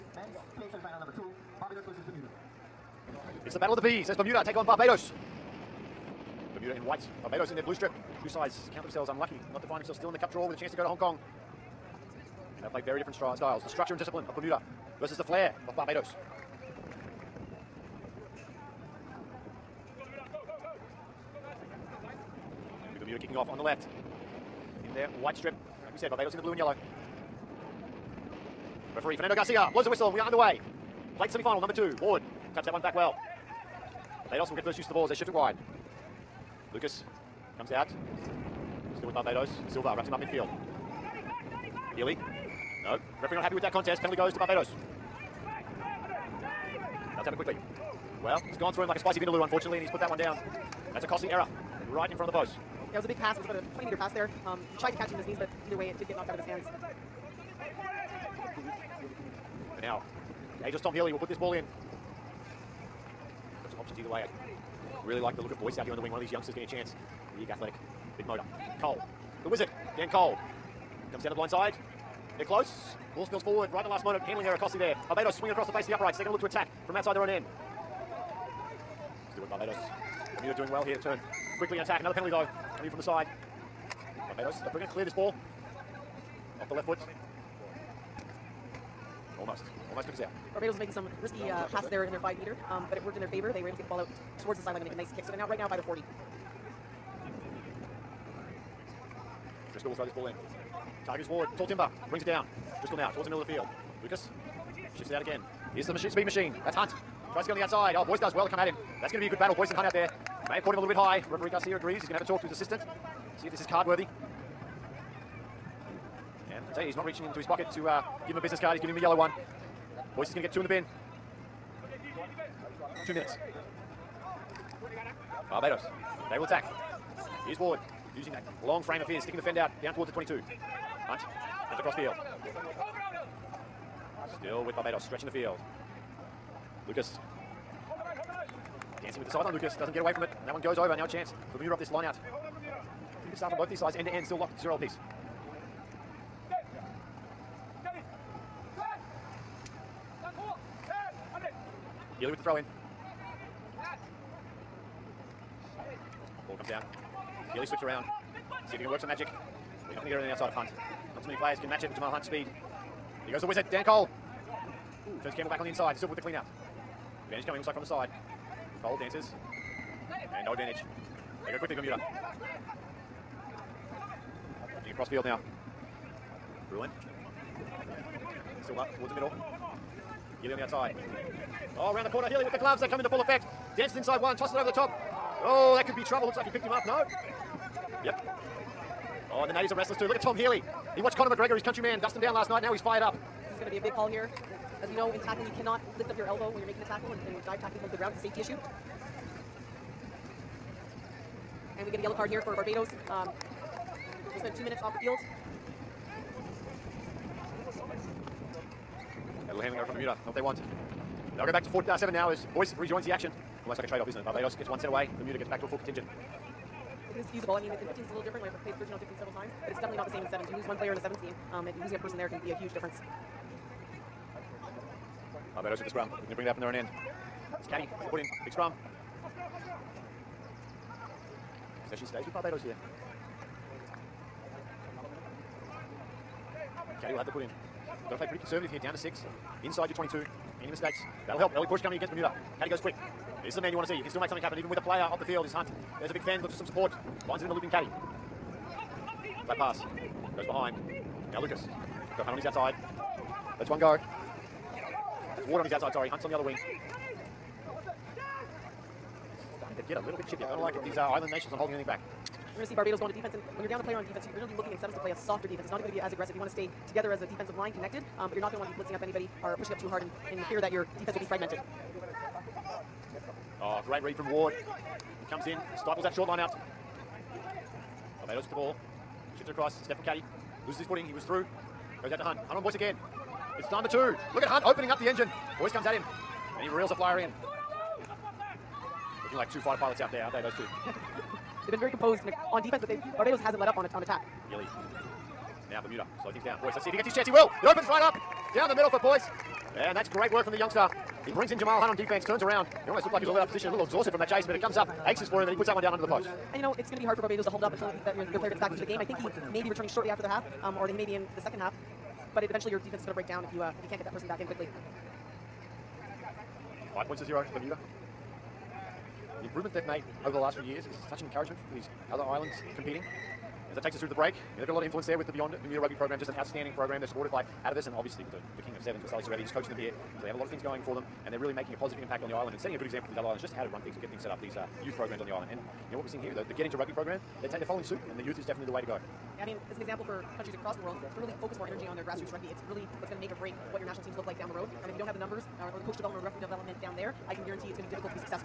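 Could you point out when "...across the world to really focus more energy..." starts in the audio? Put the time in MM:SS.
05:40.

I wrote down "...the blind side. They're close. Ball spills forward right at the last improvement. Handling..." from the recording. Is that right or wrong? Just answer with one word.
wrong.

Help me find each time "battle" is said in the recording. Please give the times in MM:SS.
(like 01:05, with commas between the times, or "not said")
00:03, 01:49.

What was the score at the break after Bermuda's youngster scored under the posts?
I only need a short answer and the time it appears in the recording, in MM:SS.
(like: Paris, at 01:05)
5-0 Bermuda, at 05:16.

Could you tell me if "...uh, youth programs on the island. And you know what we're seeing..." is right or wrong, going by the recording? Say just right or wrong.
right.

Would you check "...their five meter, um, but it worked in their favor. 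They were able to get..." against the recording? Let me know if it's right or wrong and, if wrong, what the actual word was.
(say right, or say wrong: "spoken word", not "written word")
right.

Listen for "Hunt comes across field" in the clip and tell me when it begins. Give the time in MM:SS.
02:11.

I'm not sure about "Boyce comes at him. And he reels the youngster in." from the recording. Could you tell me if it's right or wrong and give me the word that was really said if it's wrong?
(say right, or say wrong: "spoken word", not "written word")
wrong: "flyer", not "youngster".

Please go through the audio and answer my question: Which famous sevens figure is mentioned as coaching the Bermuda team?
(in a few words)
Sally Serevi.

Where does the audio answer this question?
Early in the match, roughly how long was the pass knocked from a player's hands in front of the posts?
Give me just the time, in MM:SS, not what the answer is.
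00:53.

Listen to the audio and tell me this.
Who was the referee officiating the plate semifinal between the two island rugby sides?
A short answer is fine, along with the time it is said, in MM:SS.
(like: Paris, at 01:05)
Fernando Garcia, at 00:29.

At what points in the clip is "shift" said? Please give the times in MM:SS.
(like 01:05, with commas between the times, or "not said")
00:35, 01:44, 04:39.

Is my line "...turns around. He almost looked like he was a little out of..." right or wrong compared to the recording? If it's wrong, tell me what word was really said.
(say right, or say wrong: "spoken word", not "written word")
right.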